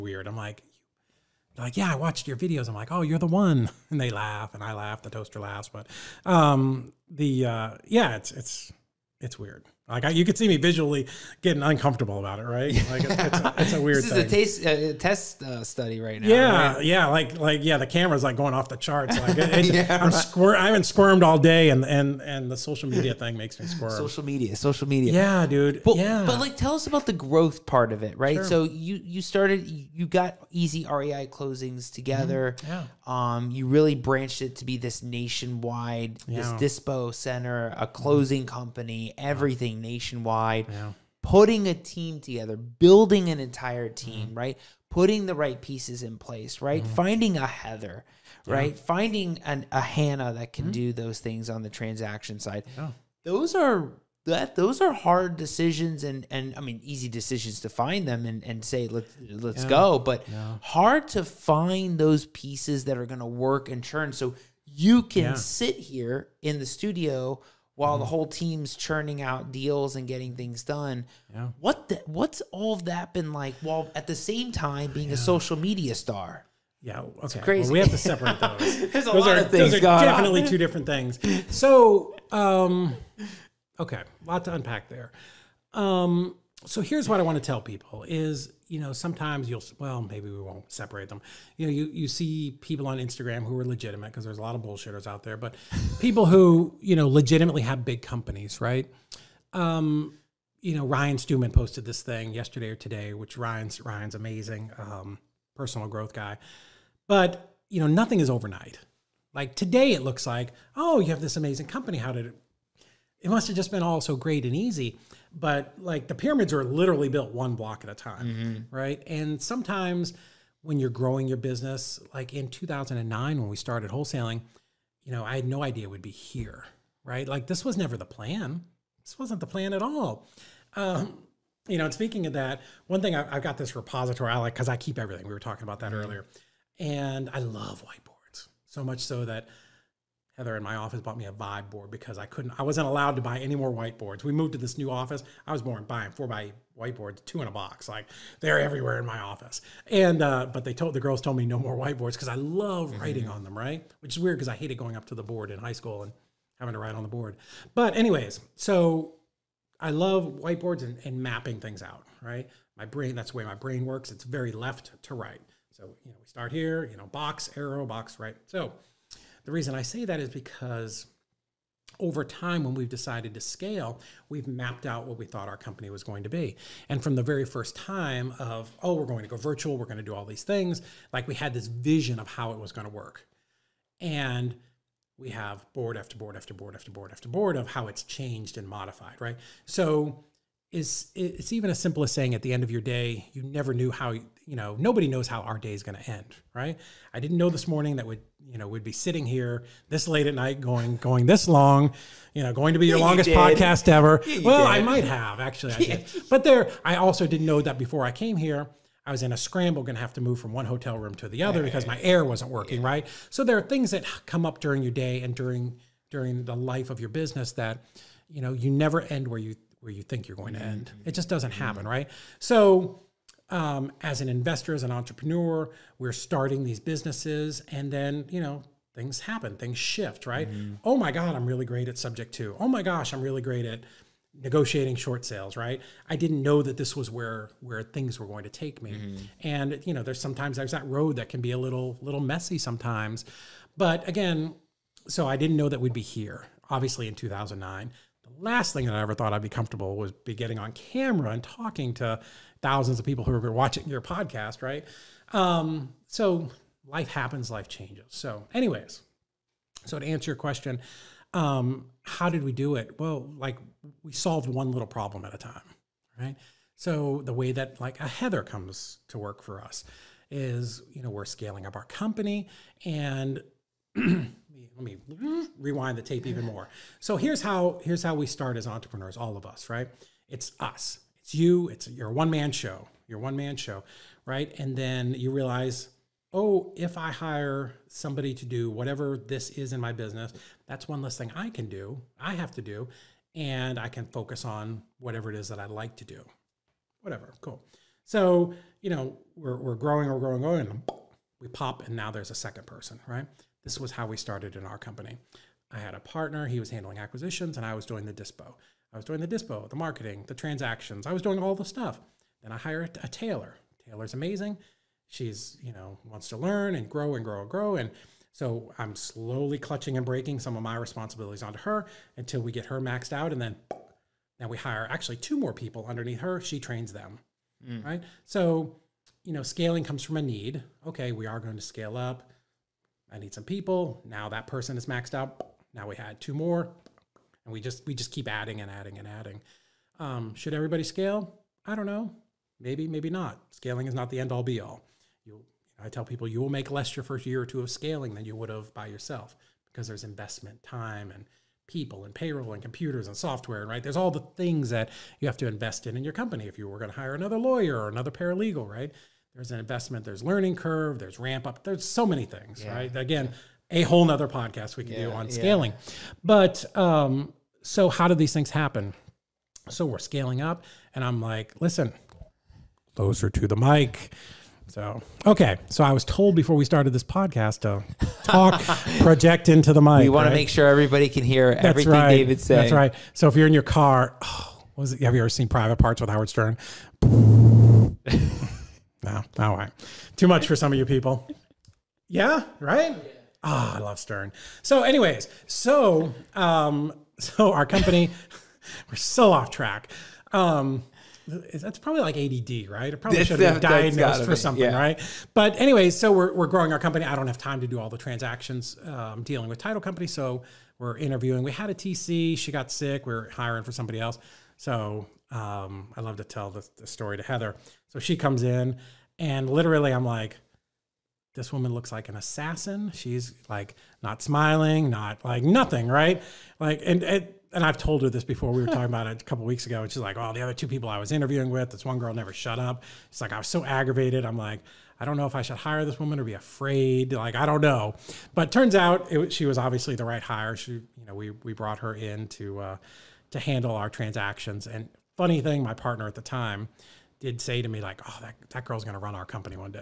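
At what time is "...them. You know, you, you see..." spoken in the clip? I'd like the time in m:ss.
1:31.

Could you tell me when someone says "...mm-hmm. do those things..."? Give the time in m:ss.
0:50.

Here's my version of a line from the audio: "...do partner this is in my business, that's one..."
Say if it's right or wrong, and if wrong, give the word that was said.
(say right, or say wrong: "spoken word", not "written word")
wrong: "whatever", not "partner".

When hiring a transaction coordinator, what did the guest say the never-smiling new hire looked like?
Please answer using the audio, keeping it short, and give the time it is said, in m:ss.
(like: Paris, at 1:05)
an assassin, at 7:02.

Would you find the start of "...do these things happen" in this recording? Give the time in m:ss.
6:08.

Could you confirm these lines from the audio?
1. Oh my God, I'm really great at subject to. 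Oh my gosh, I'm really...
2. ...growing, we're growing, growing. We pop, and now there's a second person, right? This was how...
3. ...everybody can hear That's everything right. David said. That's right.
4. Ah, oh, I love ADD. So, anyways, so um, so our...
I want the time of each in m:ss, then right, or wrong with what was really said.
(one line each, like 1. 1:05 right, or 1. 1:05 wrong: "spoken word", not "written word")
1. 3:50 right
2. 4:59 right
3. 6:20 right
4. 6:33 wrong: "Stern", not "ADD".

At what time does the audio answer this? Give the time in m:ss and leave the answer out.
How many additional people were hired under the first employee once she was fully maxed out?
5:25.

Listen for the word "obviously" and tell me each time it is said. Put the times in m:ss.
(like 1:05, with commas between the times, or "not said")
4:06, 7:19.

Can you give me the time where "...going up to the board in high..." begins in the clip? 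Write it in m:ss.
2:34.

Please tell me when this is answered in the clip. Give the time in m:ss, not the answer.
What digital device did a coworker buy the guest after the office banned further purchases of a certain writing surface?
2:21.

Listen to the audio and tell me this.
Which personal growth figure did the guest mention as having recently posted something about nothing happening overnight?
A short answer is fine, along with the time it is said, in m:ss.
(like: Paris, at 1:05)
Ryan Stewman, at 1:40.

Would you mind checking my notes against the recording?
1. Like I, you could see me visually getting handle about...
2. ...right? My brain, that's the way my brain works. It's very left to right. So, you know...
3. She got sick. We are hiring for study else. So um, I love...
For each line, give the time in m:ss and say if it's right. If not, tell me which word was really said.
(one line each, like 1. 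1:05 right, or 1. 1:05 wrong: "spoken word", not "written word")
1. 0:09 wrong: "uncomfortable", not "handle"
2. 2:42 right
3. 6:52 wrong: "somebody", not "study".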